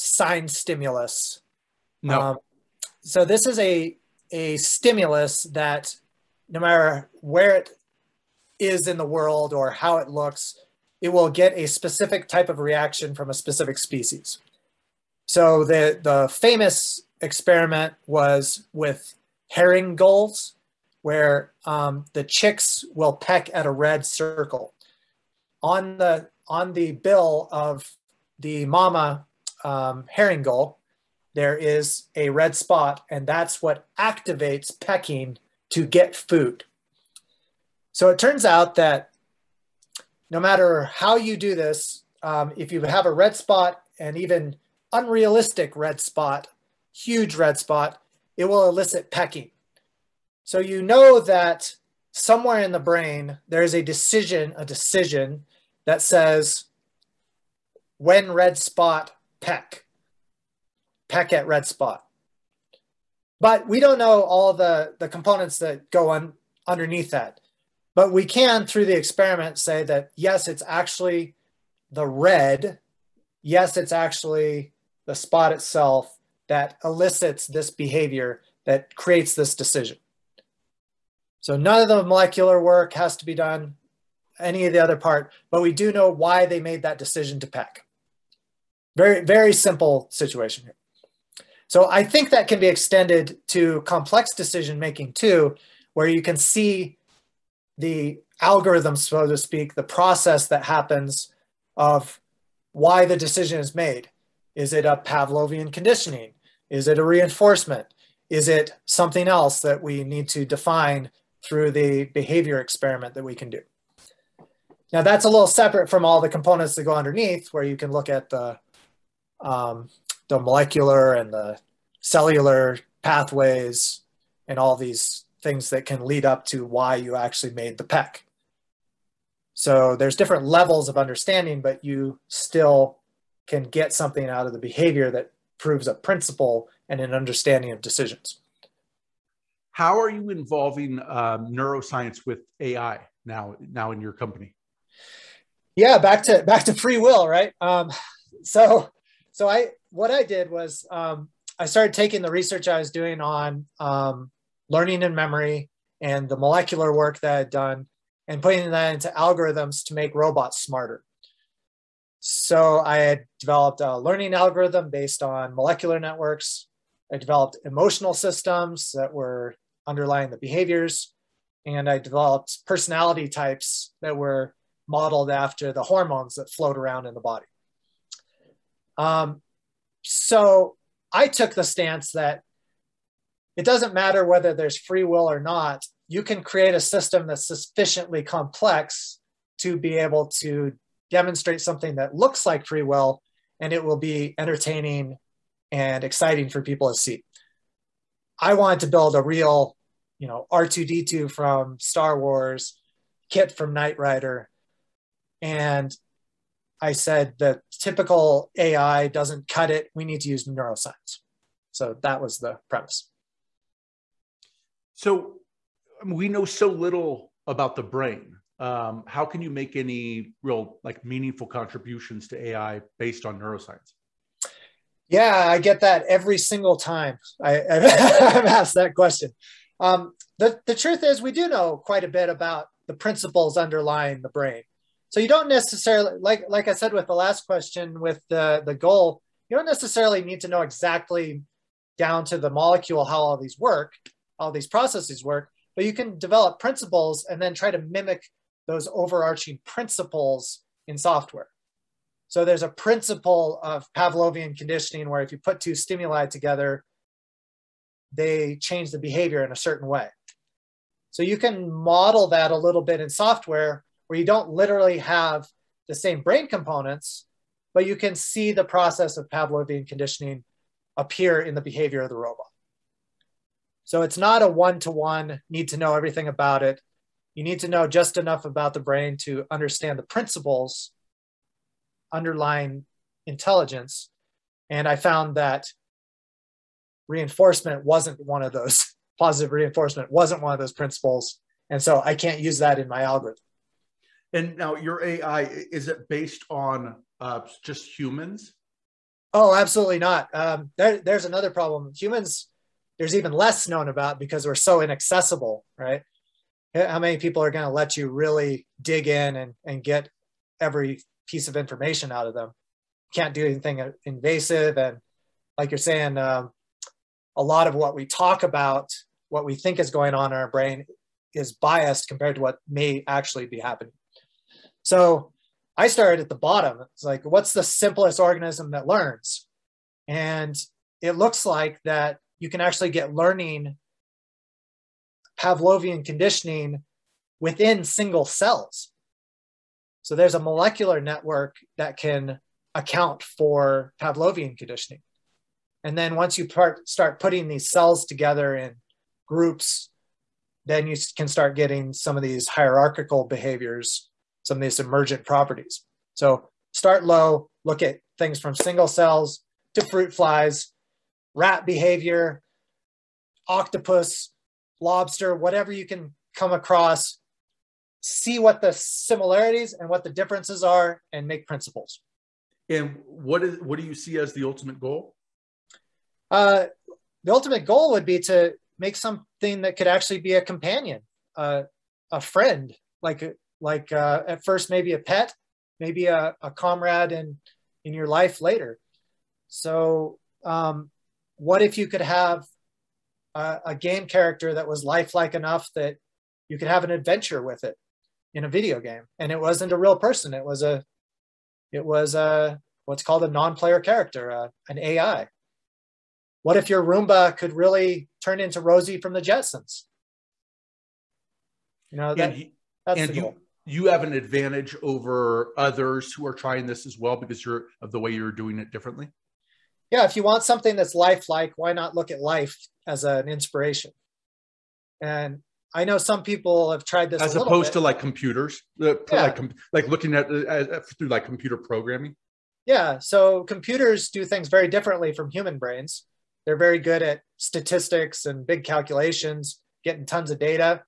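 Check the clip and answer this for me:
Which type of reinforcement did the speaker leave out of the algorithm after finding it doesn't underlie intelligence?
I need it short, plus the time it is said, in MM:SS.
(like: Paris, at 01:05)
positive reinforcement, at 04:49.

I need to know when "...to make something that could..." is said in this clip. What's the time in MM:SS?
06:18.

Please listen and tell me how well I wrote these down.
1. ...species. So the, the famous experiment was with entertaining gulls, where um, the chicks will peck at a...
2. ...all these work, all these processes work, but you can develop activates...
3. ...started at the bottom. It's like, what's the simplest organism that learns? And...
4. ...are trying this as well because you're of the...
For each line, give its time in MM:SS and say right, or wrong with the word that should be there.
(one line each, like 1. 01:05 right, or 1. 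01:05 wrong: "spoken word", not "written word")
1. 00:13 wrong: "herring", not "entertaining"
2. 04:03 wrong: "principles", not "activates"
3. 05:25 right
4. 06:56 right.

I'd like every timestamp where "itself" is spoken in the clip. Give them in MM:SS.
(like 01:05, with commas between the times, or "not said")
01:15.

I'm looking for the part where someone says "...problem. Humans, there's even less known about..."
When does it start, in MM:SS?
05:01.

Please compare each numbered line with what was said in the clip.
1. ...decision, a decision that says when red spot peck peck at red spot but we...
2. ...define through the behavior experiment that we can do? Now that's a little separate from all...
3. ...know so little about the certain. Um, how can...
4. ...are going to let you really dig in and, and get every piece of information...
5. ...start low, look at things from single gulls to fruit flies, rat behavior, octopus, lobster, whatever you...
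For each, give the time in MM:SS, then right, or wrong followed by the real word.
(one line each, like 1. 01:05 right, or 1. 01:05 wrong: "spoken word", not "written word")
1. 00:53 right
2. 01:50 right
3. 03:36 wrong: "brain", not "certain"
4. 05:07 right
5. 05:56 wrong: "cells", not "gulls".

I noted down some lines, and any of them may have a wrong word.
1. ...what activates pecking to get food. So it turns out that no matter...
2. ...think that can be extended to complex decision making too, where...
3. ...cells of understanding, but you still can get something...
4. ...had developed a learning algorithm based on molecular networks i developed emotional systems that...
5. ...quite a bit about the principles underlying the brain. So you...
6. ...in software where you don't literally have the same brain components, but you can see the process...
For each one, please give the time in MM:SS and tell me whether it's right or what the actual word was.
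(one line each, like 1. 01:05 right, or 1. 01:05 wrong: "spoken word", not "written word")
1. 00:33 right
2. 01:32 right
3. 02:10 wrong: "levels", not "cells"
4. 02:42 right
5. 03:51 right
6. 04:23 right.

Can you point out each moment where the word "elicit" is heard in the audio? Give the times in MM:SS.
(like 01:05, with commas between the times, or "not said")
00:48, 01:16.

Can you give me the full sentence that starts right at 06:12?
And what is what do you see as the ultimate goal?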